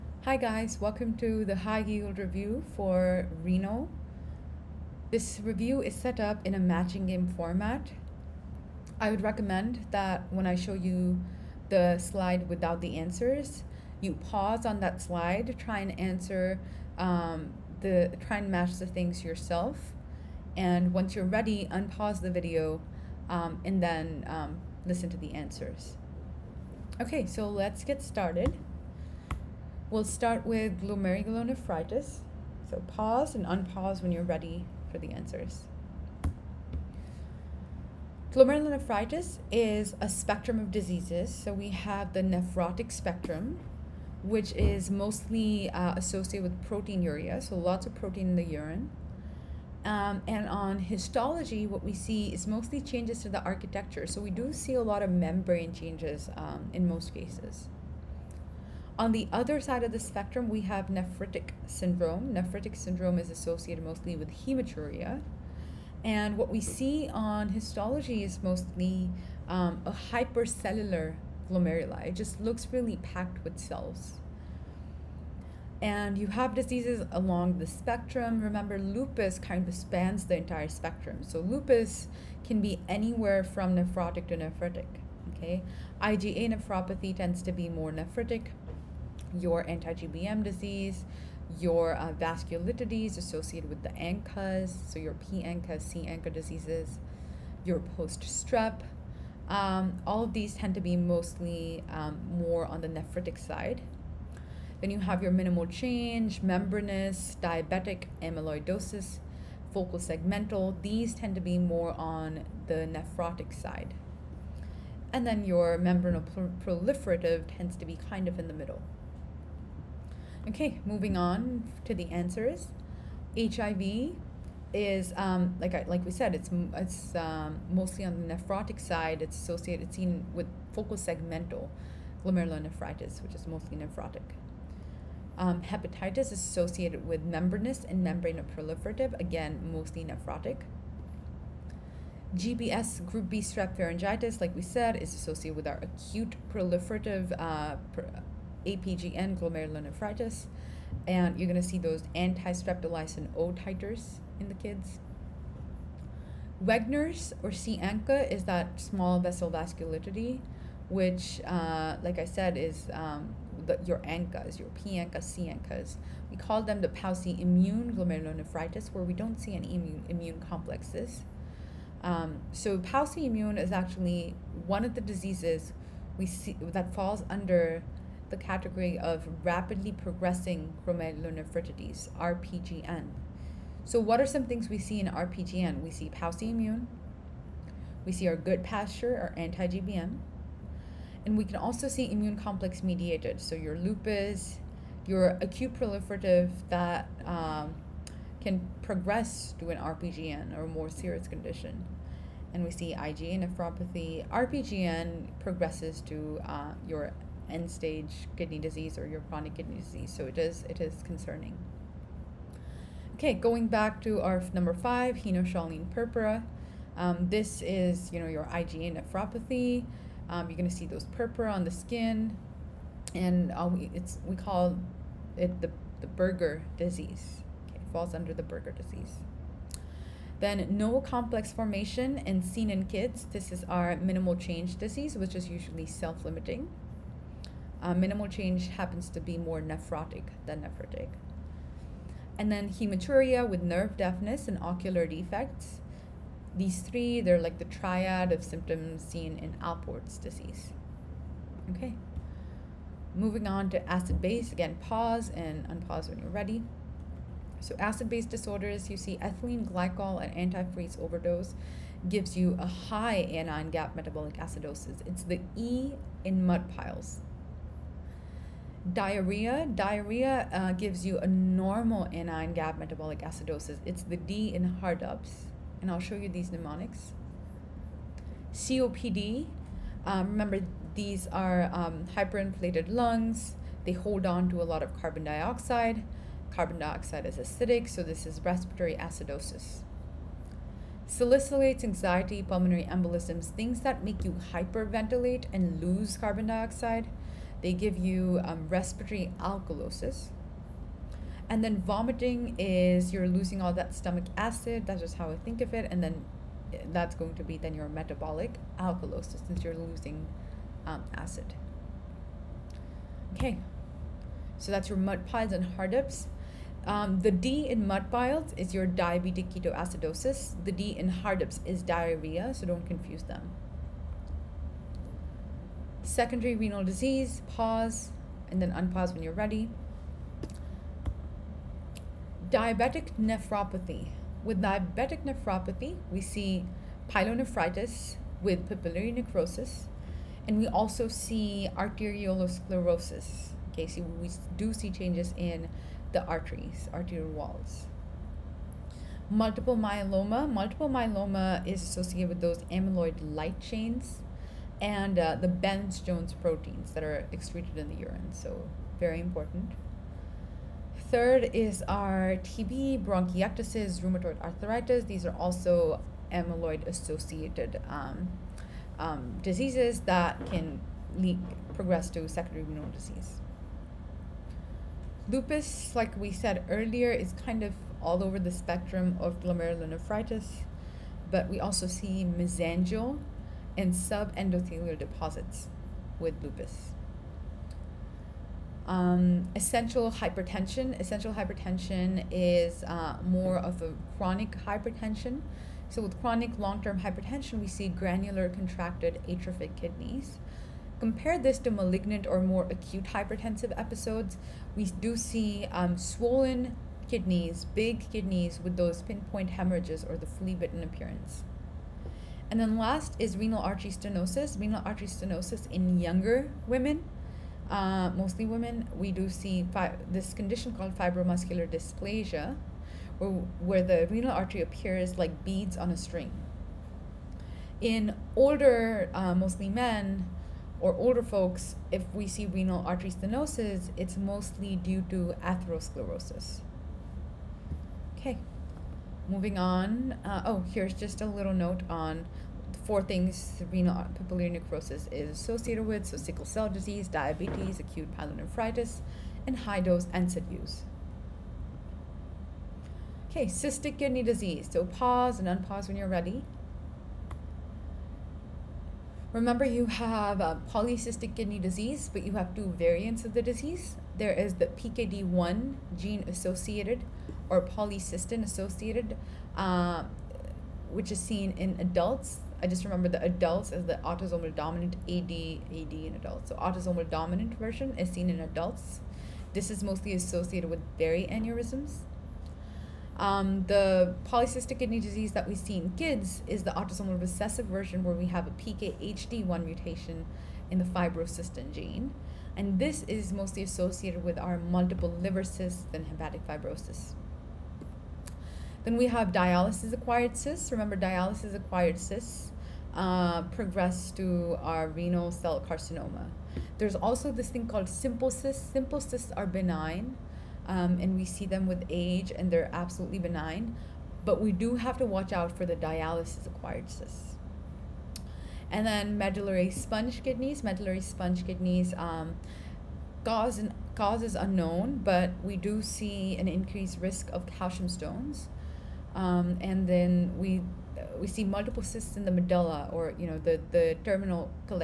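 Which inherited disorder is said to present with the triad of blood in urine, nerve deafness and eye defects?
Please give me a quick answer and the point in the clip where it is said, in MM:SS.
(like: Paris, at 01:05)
Alport's disease, at 04:09.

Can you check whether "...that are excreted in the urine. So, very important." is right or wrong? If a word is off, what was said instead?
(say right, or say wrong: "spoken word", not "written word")
right.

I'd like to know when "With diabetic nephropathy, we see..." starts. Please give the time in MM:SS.
05:34.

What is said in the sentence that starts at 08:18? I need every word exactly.
Then we have dialysis acquired cysts.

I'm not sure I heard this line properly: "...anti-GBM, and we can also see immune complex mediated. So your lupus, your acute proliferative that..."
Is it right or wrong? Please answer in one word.
right.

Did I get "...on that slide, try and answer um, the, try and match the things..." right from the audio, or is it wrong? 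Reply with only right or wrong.
right.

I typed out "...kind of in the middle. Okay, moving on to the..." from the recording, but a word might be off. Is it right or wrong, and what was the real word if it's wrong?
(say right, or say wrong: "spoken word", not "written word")
right.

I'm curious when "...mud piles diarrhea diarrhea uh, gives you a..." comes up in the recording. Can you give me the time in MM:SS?
04:26.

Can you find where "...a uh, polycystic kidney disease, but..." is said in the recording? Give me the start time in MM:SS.
07:40.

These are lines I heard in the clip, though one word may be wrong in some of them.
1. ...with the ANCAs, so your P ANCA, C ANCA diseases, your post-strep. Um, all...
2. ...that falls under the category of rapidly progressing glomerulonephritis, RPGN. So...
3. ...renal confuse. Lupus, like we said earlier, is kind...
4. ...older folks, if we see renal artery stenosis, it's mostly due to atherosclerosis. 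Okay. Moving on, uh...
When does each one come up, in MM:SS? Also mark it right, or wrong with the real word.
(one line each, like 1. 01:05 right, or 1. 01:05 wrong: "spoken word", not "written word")
1. 01:33 right
2. 02:56 right
3. 06:12 wrong: "disease", not "confuse"
4. 07:10 right.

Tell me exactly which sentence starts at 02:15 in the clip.
Um, hepatitis is associated with membranous and membranoproliferative, again mostly nephrotic.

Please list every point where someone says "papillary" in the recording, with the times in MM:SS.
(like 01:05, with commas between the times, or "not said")
05:38, 07:24.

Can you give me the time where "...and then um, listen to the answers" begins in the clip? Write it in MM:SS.
00:23.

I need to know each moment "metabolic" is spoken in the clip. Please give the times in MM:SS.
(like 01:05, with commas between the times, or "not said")
04:23, 04:32, 05:07.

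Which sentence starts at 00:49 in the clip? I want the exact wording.
Um, and on histology, what we see is mostly changes to the architecture.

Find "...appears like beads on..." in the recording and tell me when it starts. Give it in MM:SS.
07:04.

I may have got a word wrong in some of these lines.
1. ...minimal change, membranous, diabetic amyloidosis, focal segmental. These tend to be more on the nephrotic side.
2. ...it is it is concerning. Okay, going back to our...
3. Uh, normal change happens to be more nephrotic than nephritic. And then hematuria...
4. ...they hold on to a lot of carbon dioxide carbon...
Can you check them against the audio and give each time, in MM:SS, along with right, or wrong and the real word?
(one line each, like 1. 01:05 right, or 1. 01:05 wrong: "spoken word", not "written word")
1. 01:45 right
2. 03:30 right
3. 03:57 wrong: "minimal", not "normal"
4. 04:43 right.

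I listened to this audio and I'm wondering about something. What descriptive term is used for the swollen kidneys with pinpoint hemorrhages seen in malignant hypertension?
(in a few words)
Flea-bitten appearance.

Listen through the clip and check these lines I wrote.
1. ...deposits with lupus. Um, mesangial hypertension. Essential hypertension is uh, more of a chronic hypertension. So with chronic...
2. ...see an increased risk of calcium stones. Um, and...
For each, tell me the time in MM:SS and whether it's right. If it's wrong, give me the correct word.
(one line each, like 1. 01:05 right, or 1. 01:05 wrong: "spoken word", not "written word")
1. 06:24 wrong: "essential", not "mesangial"
2. 08:45 right.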